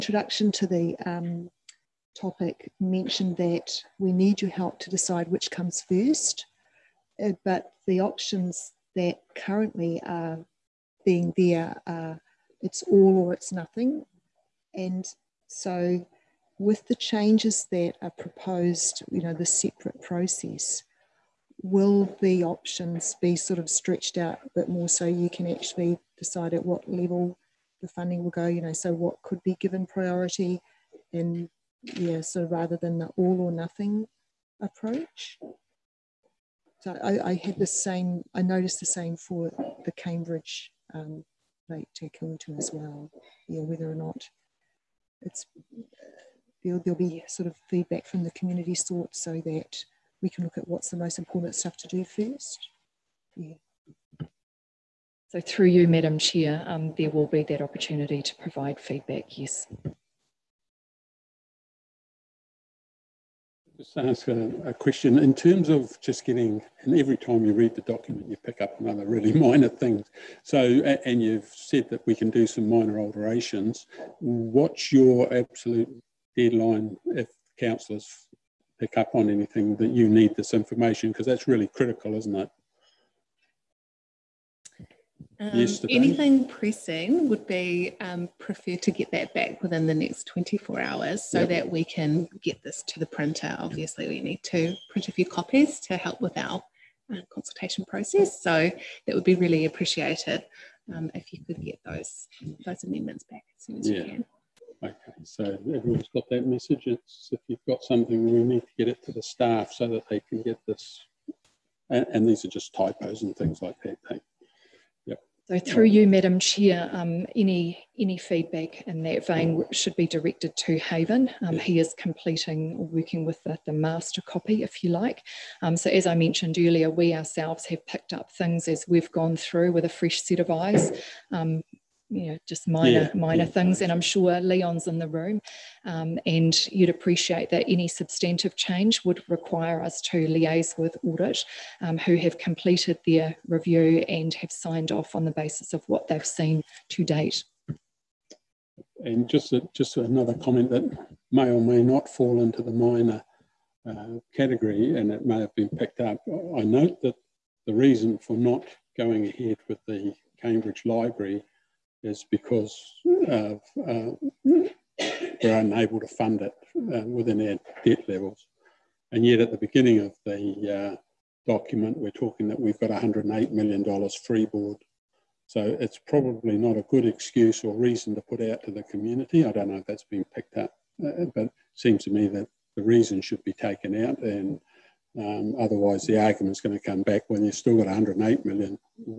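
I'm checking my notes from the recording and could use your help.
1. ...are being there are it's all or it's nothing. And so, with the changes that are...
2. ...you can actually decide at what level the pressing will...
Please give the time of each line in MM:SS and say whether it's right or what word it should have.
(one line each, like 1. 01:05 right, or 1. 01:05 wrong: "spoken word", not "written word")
1. 00:10 right
2. 00:25 wrong: "funding", not "pressing".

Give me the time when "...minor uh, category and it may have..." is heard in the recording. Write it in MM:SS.
02:32.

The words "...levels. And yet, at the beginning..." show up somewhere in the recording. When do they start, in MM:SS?
02:48.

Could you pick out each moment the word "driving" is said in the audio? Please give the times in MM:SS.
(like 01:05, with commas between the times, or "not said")
not said.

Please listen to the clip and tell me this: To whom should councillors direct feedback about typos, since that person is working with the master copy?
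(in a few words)
Haven.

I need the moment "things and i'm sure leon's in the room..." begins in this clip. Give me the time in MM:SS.
02:13.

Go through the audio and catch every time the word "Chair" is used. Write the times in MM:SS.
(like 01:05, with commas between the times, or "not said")
00:56, 01:56.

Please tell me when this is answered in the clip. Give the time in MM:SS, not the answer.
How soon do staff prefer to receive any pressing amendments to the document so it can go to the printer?
01:30.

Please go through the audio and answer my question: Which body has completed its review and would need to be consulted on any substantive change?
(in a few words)
audit.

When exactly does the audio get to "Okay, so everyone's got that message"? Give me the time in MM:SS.
01:44.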